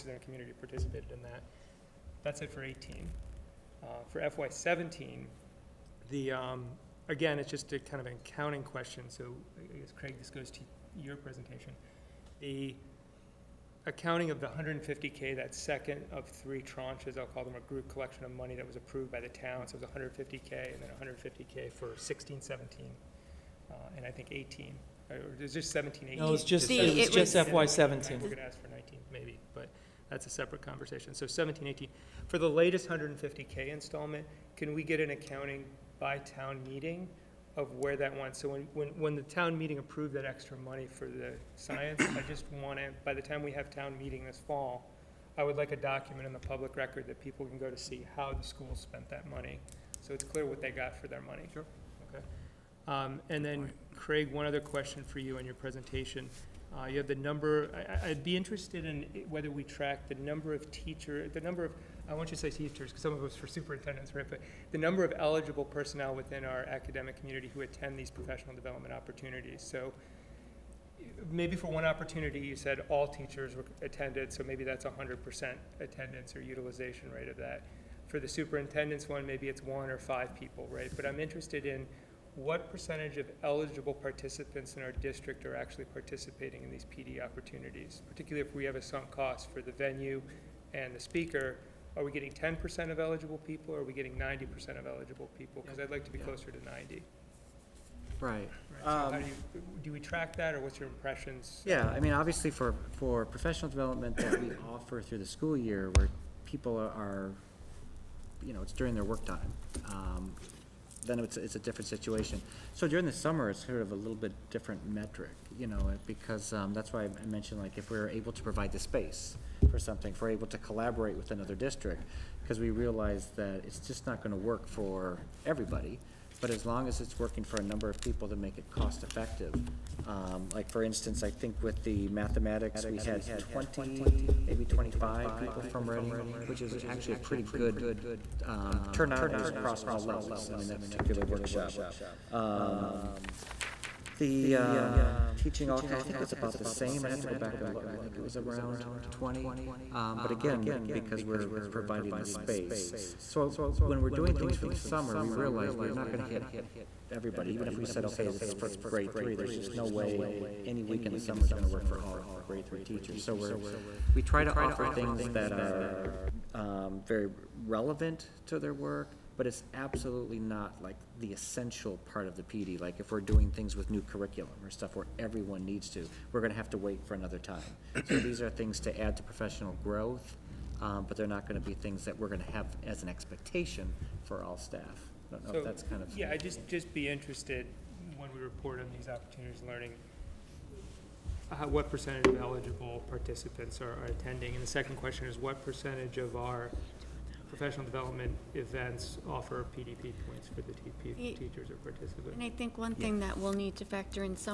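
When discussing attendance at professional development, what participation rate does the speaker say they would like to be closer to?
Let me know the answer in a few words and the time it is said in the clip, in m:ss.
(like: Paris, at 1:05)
90%, at 1:36.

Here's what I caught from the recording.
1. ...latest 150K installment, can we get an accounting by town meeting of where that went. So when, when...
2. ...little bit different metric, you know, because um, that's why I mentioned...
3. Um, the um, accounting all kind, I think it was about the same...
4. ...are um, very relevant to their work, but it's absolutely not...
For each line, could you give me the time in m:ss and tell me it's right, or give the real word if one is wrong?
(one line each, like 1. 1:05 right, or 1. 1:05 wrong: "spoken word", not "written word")
1. 0:32 right
2. 1:53 right
3. 2:22 wrong: "teaching", not "accounting"
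4. 2:45 right.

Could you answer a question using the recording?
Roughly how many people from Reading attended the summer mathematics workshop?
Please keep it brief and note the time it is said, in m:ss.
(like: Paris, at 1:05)
20 to 25, at 2:13.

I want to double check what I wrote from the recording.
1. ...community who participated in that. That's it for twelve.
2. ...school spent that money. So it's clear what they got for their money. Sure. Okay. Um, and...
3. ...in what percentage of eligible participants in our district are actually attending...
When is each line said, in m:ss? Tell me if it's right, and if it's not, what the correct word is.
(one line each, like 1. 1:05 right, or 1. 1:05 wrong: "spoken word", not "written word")
1. 0:00 wrong: "eighteen", not "twelve"
2. 0:48 right
3. 1:21 wrong: "participating", not "attending".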